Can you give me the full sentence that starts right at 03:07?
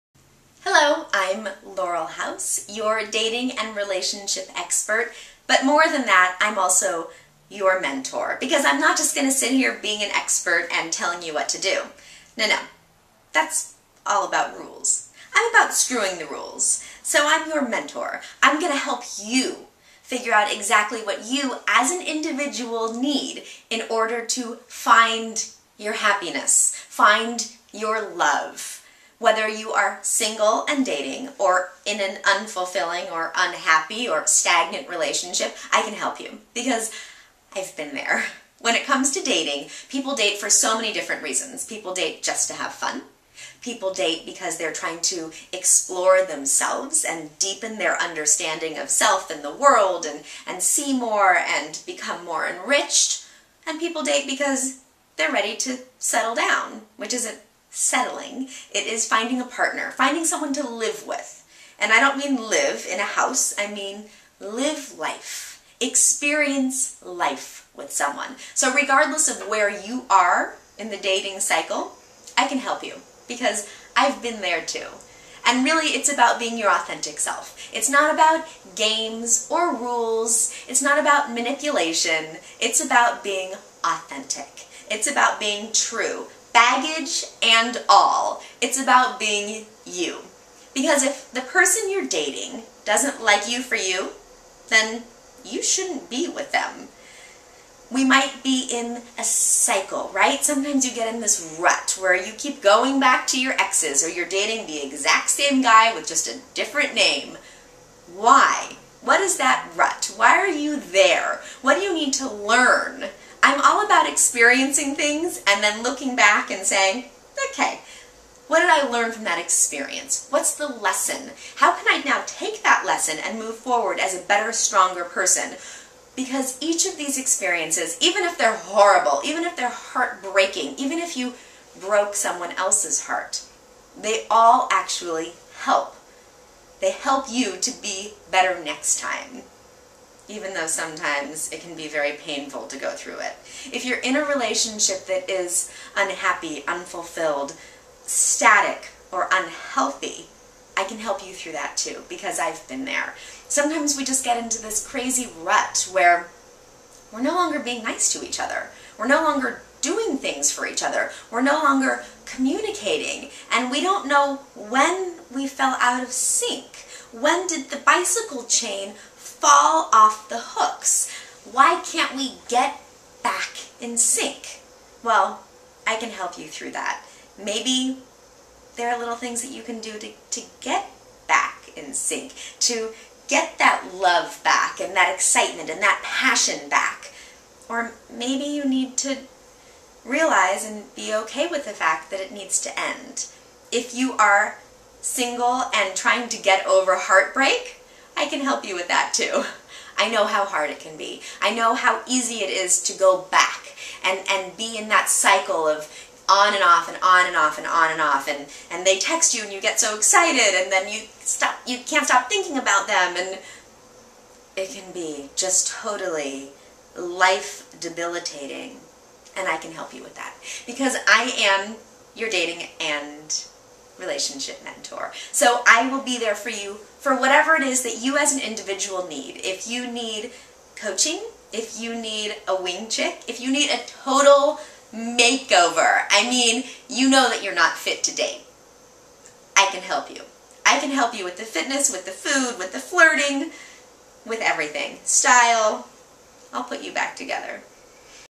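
Or maybe you need to realize and be okay with the fact that it needs to end.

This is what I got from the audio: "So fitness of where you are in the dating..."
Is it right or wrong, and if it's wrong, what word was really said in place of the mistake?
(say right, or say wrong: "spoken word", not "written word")
wrong: "regardless", not "fitness".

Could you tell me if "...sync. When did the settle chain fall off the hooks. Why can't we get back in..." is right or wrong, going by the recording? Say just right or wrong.
wrong.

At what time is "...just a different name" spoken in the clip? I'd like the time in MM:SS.
01:46.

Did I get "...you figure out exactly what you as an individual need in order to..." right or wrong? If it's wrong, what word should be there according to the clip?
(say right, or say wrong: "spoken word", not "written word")
right.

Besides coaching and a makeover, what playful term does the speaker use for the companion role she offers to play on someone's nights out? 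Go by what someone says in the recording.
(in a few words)
wing chick.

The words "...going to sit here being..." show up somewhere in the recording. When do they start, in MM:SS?
00:09.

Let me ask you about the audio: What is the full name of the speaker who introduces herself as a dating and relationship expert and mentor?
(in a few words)
Laurel House.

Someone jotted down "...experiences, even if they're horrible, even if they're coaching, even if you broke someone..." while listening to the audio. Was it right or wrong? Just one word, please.
wrong.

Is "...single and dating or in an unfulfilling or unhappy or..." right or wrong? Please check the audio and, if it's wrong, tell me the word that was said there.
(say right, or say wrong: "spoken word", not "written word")
right.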